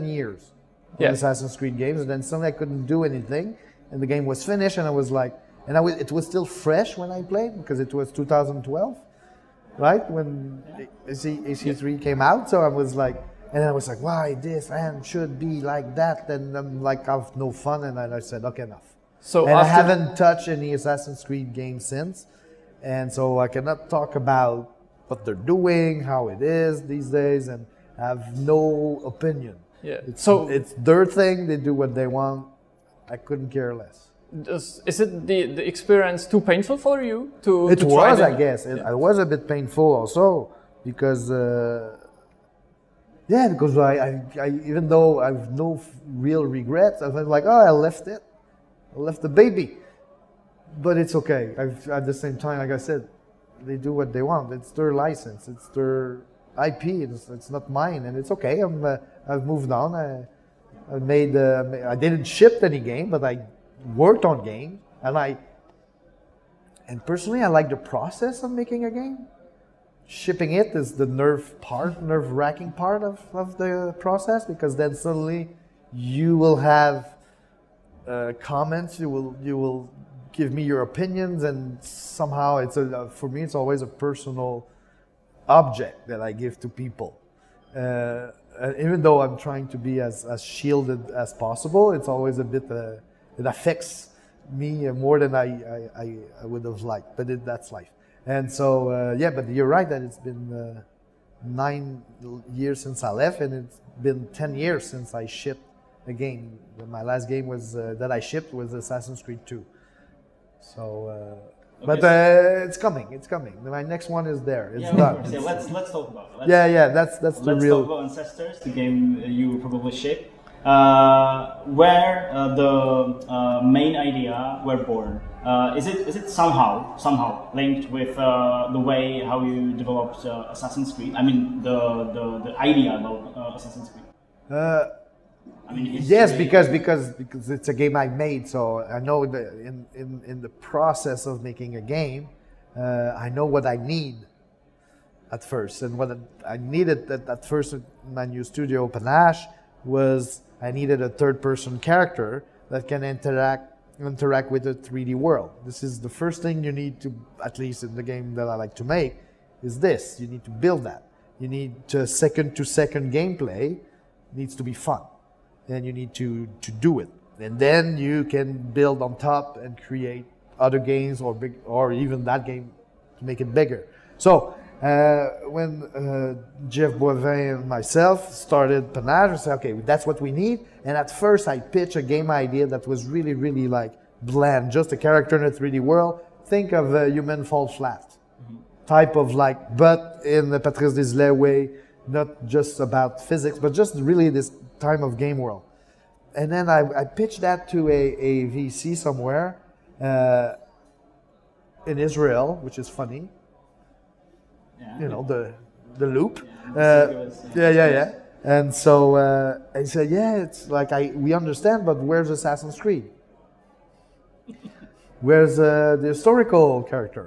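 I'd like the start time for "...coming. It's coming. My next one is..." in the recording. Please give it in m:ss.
1:52.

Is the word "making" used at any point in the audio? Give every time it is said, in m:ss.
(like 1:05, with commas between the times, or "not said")
1:08, 2:21.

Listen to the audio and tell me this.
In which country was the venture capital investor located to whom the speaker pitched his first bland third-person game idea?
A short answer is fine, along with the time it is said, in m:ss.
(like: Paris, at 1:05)
Israel, at 3:21.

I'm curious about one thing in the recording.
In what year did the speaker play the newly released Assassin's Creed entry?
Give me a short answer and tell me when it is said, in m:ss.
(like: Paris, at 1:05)
2012, at 0:08.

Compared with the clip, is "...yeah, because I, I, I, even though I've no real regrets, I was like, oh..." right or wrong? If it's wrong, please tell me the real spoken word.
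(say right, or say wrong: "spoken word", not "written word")
right.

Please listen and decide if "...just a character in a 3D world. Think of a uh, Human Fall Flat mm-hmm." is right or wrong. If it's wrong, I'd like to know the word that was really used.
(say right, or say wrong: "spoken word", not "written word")
right.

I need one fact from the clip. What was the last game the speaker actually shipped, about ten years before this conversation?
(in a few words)
Assassin's Creed 2.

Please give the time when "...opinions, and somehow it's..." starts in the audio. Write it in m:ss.
1:20.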